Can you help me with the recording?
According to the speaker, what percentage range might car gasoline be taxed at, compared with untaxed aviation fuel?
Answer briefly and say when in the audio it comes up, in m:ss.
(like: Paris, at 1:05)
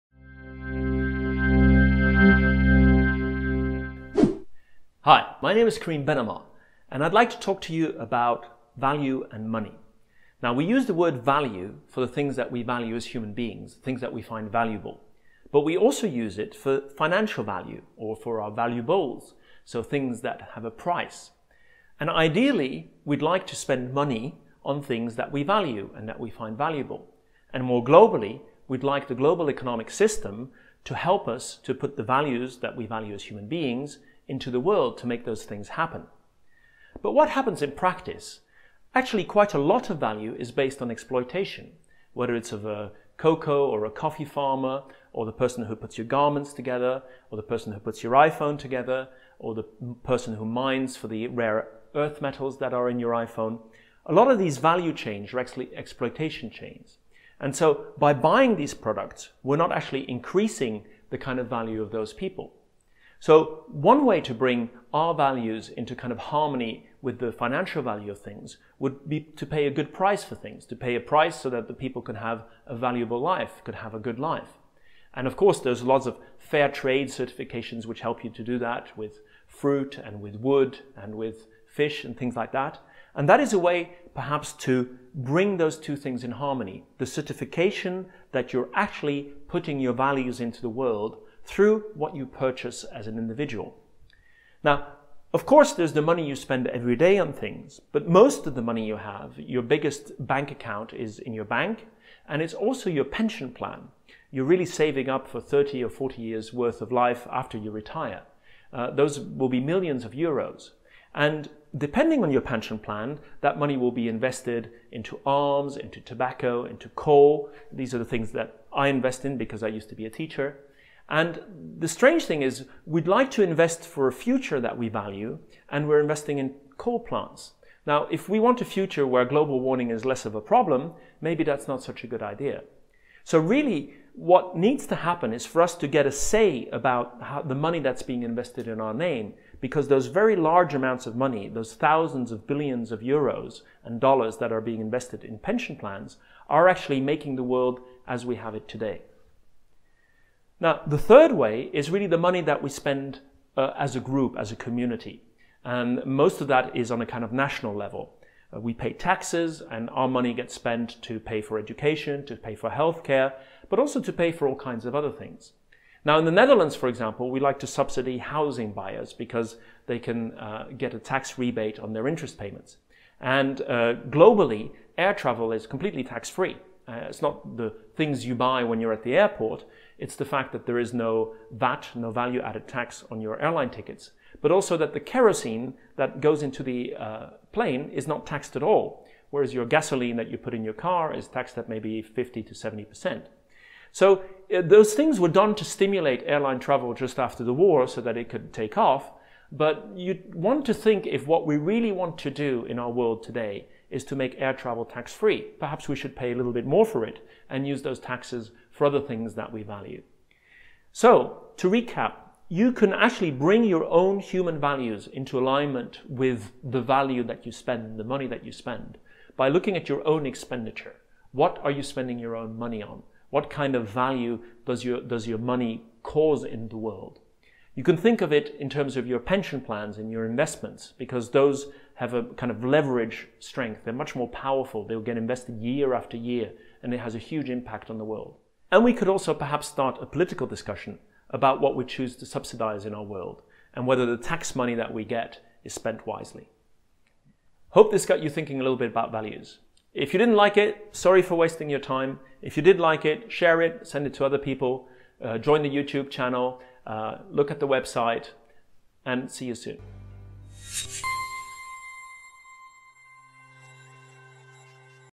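50 to 70 percent, at 3:12.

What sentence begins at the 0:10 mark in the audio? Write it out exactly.
Now, we use the word value for the things that we value as human beings, things that we find valuable.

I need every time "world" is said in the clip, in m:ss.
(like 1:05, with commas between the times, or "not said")
0:34, 1:30, 2:27, 3:22, 3:46, 3:58, 4:03.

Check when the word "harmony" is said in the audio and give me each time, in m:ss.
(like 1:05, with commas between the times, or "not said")
1:06, 1:26.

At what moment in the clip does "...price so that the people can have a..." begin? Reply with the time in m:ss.
1:10.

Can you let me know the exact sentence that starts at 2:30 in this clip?
Now, the third way is really the money that we spend uh, as a group, as a community.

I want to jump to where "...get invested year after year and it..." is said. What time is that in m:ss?
3:54.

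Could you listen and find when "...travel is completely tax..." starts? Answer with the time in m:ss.
2:55.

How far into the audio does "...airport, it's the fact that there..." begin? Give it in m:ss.
2:59.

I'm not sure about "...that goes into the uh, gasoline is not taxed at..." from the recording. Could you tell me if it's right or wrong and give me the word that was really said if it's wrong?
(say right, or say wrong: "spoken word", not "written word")
wrong: "plane", not "gasoline".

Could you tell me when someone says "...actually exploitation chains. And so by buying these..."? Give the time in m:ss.
0:55.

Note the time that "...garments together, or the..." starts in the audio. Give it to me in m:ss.
0:46.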